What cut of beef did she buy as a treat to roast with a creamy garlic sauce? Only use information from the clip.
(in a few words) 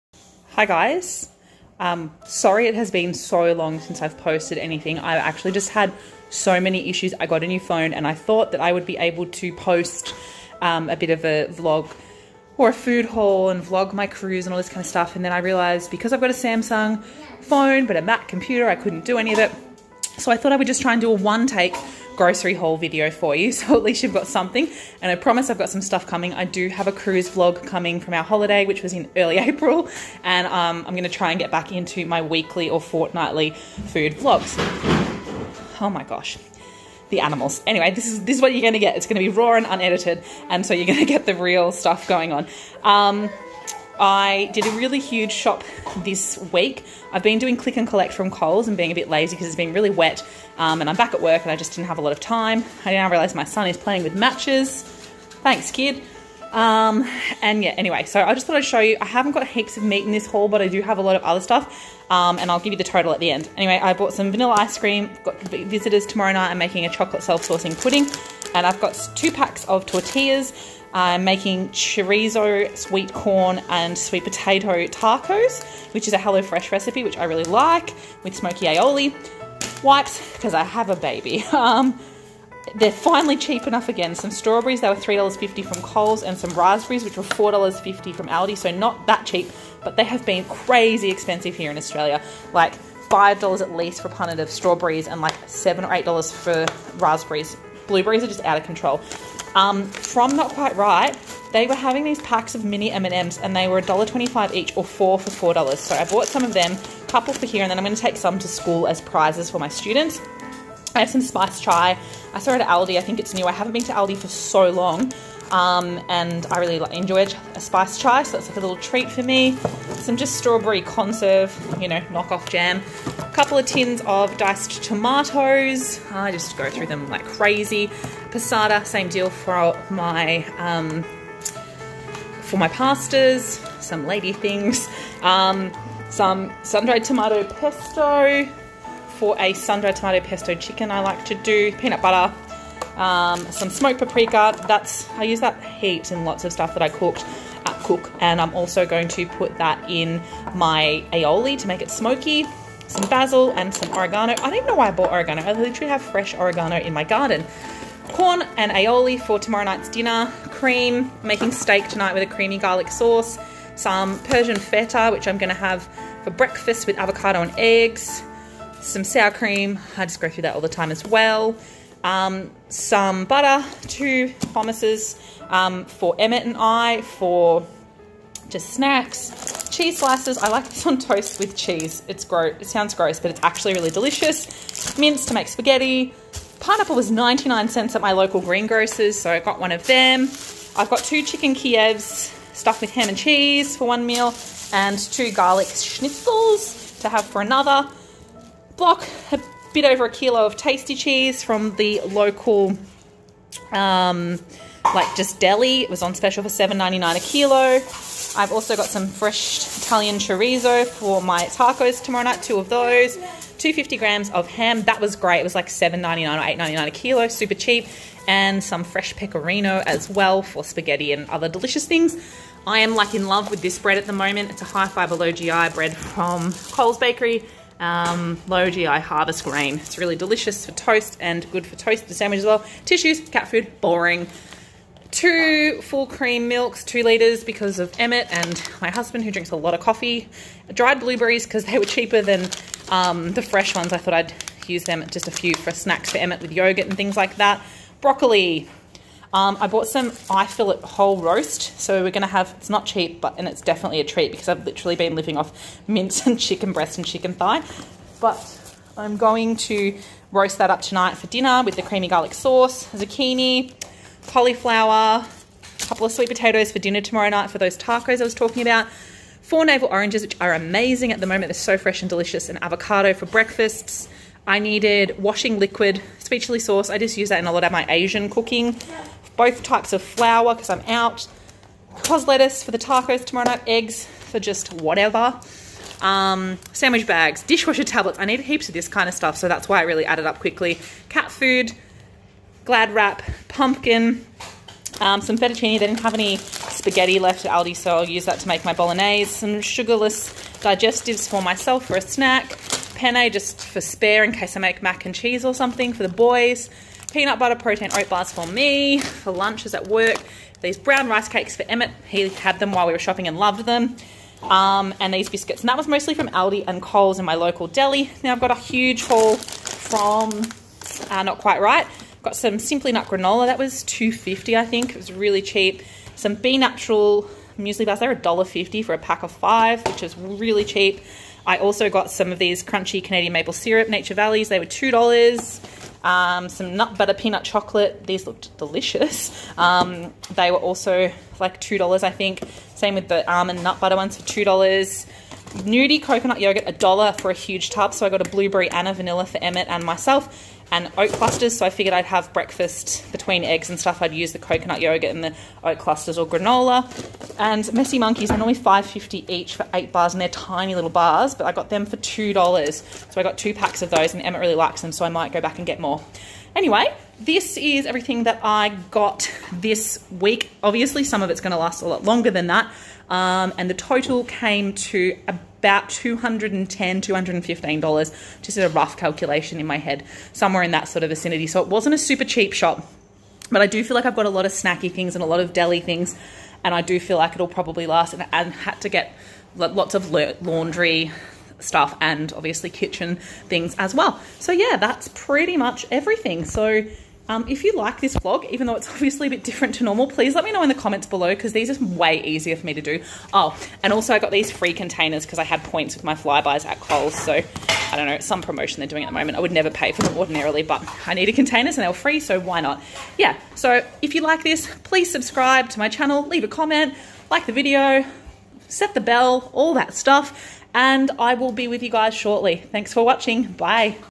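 Eye fillet.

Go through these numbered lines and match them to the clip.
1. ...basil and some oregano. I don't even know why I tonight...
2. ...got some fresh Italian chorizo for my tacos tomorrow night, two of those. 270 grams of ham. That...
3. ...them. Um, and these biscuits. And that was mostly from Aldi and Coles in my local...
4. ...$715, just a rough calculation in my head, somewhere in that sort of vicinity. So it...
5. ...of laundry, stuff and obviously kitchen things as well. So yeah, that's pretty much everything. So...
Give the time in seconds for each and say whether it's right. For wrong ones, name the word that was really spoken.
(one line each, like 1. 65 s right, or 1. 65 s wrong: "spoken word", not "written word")
1. 153 s wrong: "bought", not "tonight"
2. 208 s wrong: "250", not "270"
3. 313 s right
4. 376 s wrong: "215", not "715"
5. 389 s right.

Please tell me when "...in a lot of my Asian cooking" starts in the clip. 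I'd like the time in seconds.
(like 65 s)
277 s.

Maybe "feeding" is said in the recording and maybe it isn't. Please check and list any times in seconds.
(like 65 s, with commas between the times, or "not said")
not said.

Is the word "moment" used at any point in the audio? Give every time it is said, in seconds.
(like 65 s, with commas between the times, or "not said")
224 s, 271 s, 409 s.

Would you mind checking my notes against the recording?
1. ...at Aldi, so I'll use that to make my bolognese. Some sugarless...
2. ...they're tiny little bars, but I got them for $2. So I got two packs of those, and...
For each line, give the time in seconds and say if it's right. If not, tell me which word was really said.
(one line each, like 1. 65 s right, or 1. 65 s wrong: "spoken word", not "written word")
1. 297 s right
2. 360 s right.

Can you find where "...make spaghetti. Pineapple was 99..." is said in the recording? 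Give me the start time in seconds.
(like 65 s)
185 s.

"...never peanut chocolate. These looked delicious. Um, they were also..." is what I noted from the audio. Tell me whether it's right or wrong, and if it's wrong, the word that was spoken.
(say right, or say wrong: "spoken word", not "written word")
wrong: "butter", not "never".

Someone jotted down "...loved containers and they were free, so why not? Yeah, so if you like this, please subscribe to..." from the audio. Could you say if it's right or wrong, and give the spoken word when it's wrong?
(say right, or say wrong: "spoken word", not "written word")
wrong: "needed", not "loved".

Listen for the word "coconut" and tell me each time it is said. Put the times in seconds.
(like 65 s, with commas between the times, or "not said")
346 s, 354 s.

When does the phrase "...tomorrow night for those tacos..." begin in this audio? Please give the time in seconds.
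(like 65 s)
267 s.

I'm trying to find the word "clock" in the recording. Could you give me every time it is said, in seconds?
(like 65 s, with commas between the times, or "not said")
not said.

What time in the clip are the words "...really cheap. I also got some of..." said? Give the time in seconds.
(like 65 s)
330 s.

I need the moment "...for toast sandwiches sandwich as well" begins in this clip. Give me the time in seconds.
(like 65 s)
231 s.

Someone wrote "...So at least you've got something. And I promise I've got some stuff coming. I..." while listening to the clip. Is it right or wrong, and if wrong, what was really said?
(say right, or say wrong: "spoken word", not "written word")
right.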